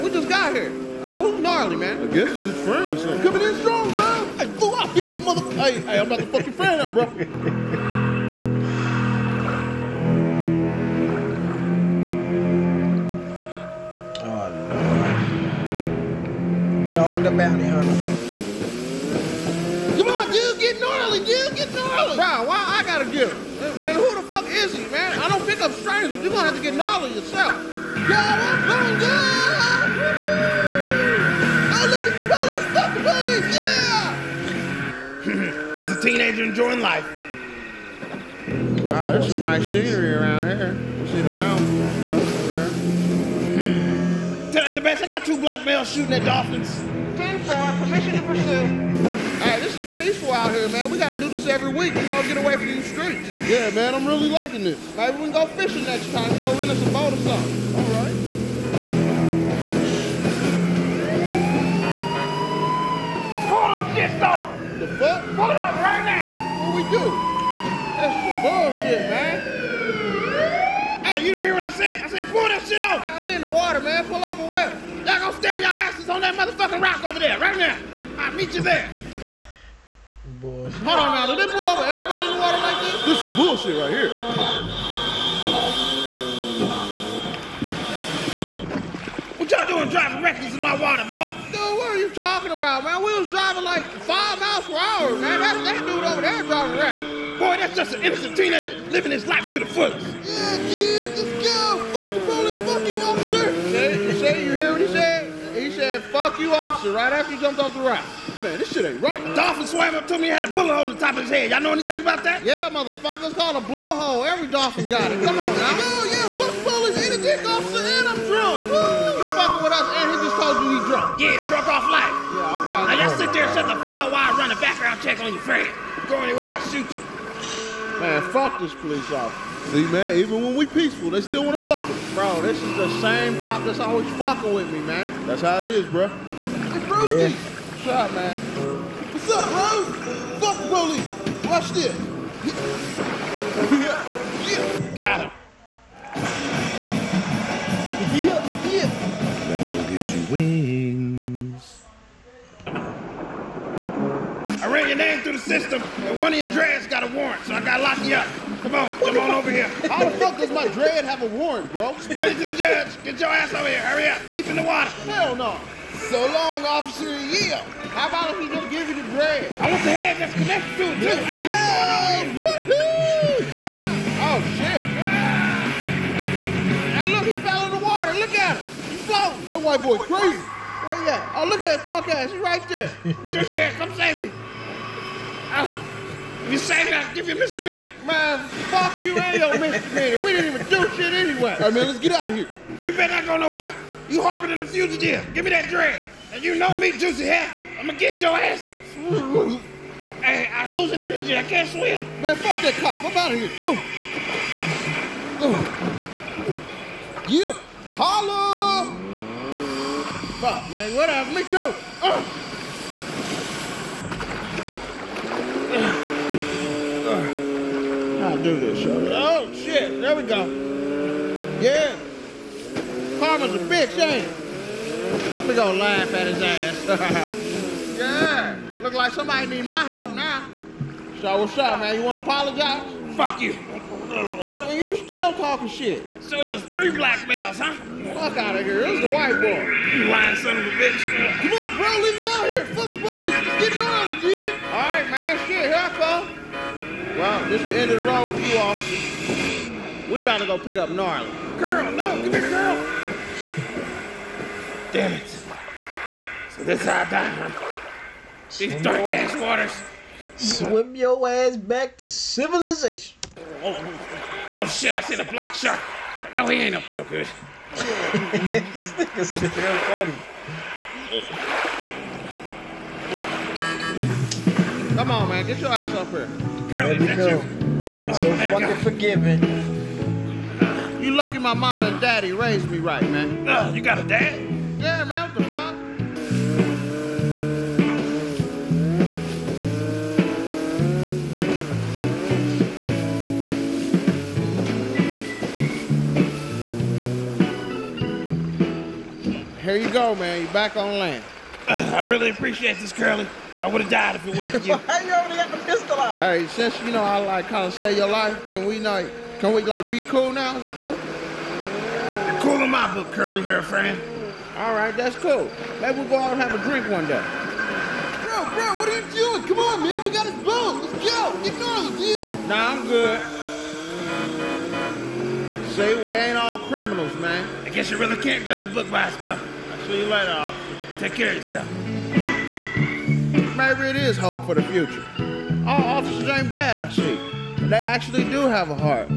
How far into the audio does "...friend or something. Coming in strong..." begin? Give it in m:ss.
0:02.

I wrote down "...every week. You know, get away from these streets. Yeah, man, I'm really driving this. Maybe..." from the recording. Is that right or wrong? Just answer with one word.
wrong.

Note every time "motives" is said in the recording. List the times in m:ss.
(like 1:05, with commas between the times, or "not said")
not said.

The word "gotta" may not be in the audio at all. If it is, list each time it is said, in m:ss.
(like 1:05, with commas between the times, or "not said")
0:22, 2:37.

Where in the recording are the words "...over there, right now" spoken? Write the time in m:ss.
1:17.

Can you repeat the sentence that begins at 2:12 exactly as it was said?
Bro, this is the same cop that's always fucking with me, man.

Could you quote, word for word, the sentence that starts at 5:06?
Hey, since you know I like kind of save your life, can we like can we like be cool now?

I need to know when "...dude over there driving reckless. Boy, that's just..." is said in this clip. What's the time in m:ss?
1:35.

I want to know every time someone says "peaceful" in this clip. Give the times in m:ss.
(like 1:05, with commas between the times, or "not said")
0:49, 2:10.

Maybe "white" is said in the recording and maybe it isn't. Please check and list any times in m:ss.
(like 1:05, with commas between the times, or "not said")
2:59, 3:59.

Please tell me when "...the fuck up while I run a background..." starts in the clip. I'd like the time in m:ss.
2:03.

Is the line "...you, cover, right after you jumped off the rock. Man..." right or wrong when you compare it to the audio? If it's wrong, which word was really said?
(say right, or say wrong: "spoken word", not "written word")
wrong: "officer", not "cover".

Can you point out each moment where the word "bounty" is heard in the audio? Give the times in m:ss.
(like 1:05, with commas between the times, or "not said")
0:17.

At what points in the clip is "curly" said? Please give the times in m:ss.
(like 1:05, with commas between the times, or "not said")
5:02, 5:13.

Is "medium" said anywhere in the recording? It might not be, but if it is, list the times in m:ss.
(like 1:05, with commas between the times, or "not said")
not said.